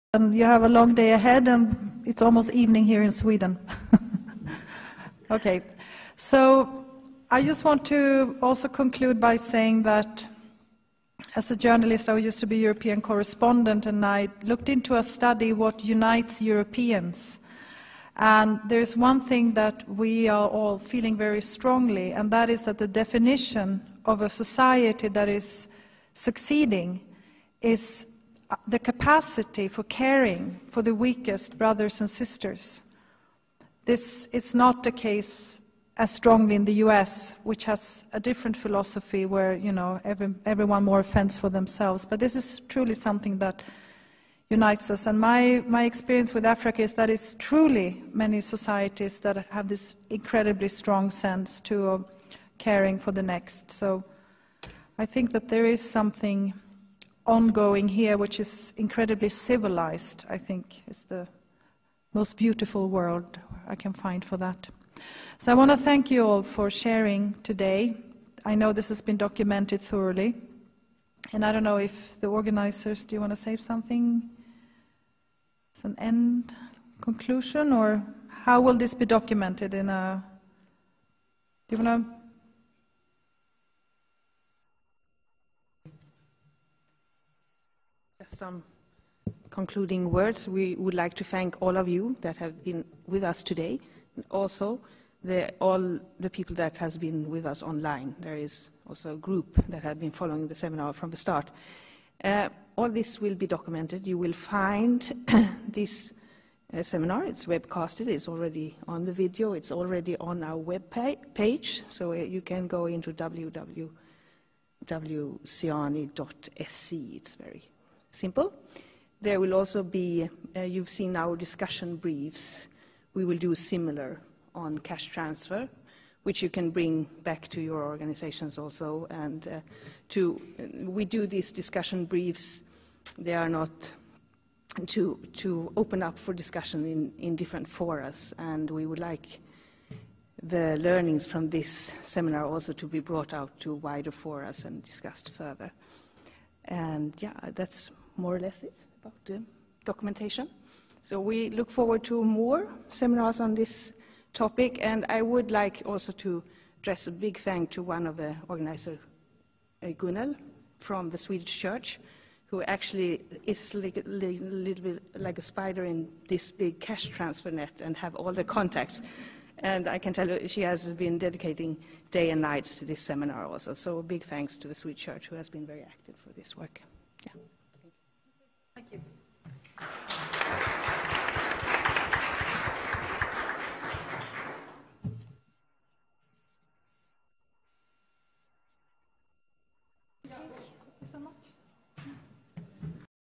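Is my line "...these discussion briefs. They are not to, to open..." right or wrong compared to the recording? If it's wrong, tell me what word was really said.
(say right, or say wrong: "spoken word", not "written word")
right.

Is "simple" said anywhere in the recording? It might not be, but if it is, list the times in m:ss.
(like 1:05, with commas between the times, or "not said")
1:58.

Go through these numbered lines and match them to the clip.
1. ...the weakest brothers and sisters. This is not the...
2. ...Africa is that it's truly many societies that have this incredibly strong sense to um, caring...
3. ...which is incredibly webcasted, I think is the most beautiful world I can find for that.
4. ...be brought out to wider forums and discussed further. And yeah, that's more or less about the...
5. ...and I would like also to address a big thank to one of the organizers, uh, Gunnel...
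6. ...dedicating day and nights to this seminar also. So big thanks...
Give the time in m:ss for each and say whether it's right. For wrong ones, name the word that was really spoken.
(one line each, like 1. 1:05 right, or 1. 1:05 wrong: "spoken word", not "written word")
1. 0:30 right
2. 0:46 right
3. 0:58 wrong: "civilized", not "webcasted"
4. 2:22 right
5. 2:34 right
6. 2:51 right.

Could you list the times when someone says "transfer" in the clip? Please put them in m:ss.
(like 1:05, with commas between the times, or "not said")
2:05, 2:47.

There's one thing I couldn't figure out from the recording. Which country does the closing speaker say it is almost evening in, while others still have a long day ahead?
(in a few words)
Sweden.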